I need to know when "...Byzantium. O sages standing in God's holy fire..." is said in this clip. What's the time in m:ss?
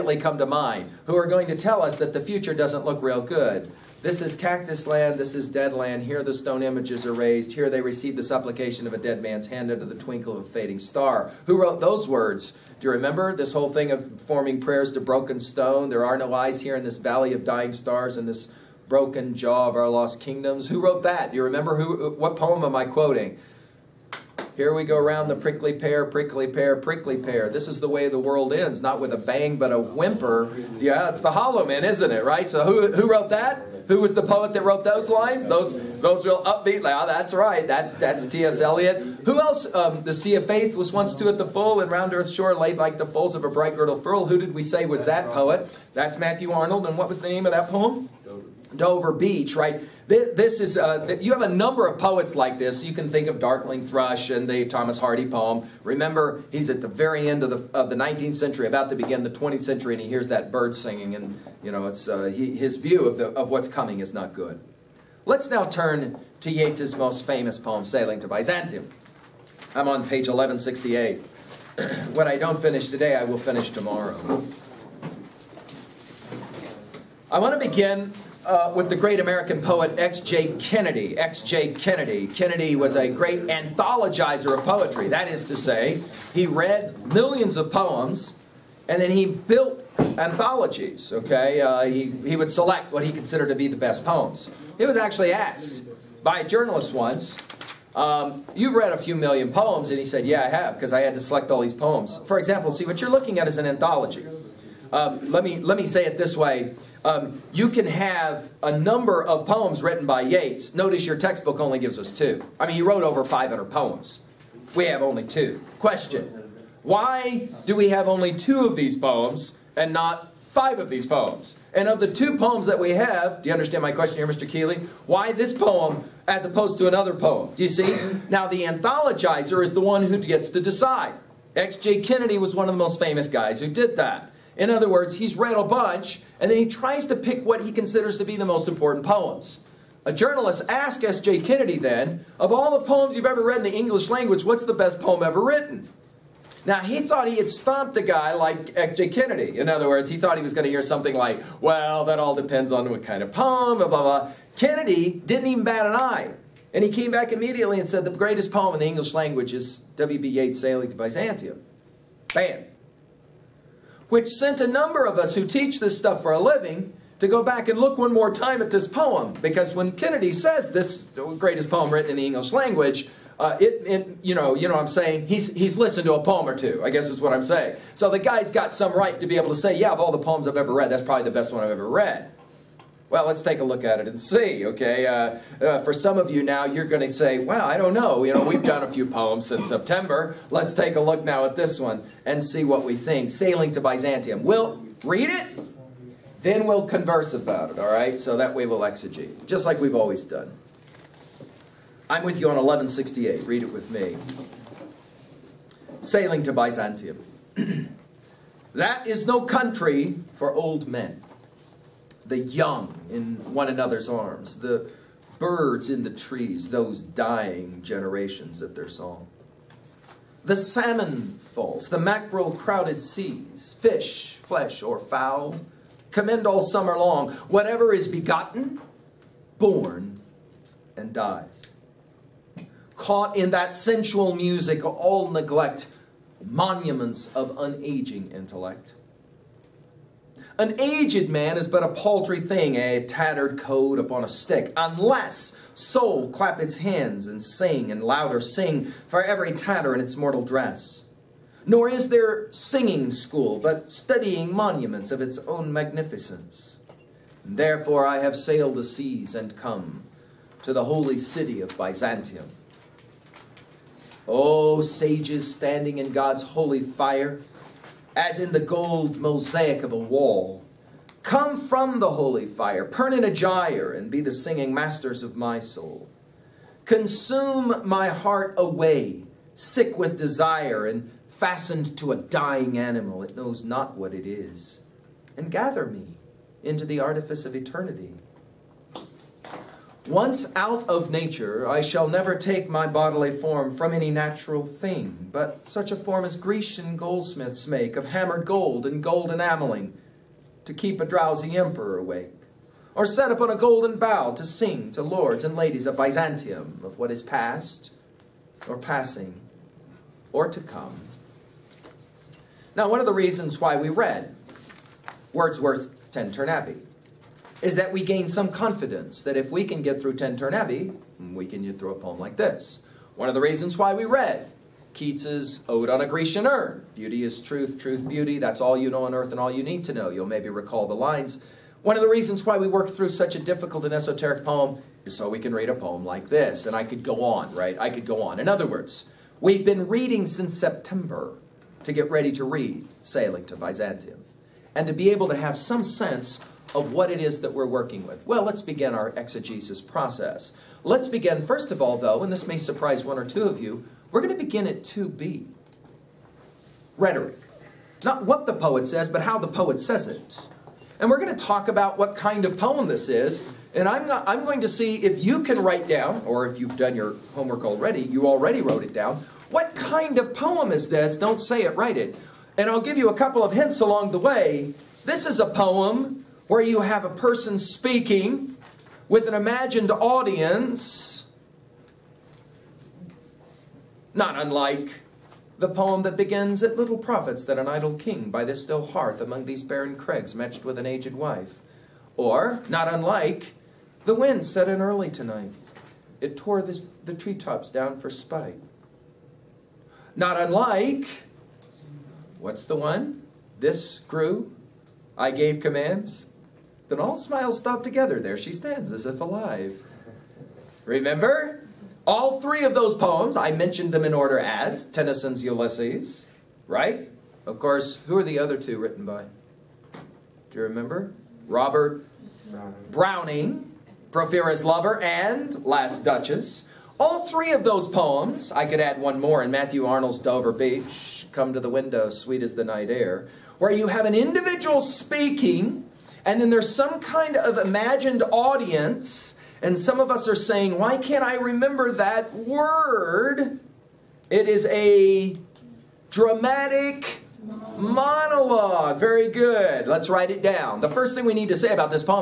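4:21.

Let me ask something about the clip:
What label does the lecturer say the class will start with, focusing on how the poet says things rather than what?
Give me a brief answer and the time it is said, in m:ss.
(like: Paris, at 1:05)
2b rhetoric, at 5:54.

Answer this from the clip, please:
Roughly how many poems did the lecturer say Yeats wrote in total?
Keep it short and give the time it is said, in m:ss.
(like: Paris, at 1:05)
over 500, at 1:53.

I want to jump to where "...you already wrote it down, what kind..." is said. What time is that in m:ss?
6:08.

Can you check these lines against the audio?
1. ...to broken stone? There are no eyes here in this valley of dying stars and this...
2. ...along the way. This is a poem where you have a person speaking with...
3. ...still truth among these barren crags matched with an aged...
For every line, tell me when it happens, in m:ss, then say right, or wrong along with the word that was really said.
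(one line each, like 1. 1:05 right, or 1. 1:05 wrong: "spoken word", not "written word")
1. 0:14 right
2. 6:13 right
3. 6:28 wrong: "hearth", not "truth".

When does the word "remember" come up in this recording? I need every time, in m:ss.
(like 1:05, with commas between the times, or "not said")
0:12, 0:21, 0:55, 6:50, 7:00, 7:21.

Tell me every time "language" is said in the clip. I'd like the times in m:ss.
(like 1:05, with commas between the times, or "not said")
2:24, 2:39, 2:52.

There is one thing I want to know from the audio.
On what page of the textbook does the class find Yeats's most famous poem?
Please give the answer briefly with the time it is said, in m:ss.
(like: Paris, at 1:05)
1168, at 1:10.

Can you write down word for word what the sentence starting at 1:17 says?
I want to begin uh, with the great American poet X.J.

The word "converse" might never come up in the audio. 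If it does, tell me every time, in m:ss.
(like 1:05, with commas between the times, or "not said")
3:16.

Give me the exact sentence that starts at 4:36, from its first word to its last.
Consume my heart away, sick with desire, and fastened to a dying animal.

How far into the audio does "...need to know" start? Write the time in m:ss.
5:29.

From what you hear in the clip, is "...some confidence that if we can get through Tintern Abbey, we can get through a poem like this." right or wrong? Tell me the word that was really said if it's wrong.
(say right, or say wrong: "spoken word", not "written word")
right.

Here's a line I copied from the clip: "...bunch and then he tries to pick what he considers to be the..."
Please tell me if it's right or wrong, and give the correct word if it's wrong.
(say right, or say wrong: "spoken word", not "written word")
right.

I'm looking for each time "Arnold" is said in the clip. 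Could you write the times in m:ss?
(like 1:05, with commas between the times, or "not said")
0:46, 7:09.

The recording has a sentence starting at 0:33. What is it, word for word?
Who was the poet that wrote those lines?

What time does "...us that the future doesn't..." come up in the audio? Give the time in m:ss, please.
0:01.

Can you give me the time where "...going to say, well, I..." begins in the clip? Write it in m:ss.
3:06.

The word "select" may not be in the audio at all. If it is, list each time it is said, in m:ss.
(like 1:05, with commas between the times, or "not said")
1:32, 1:41.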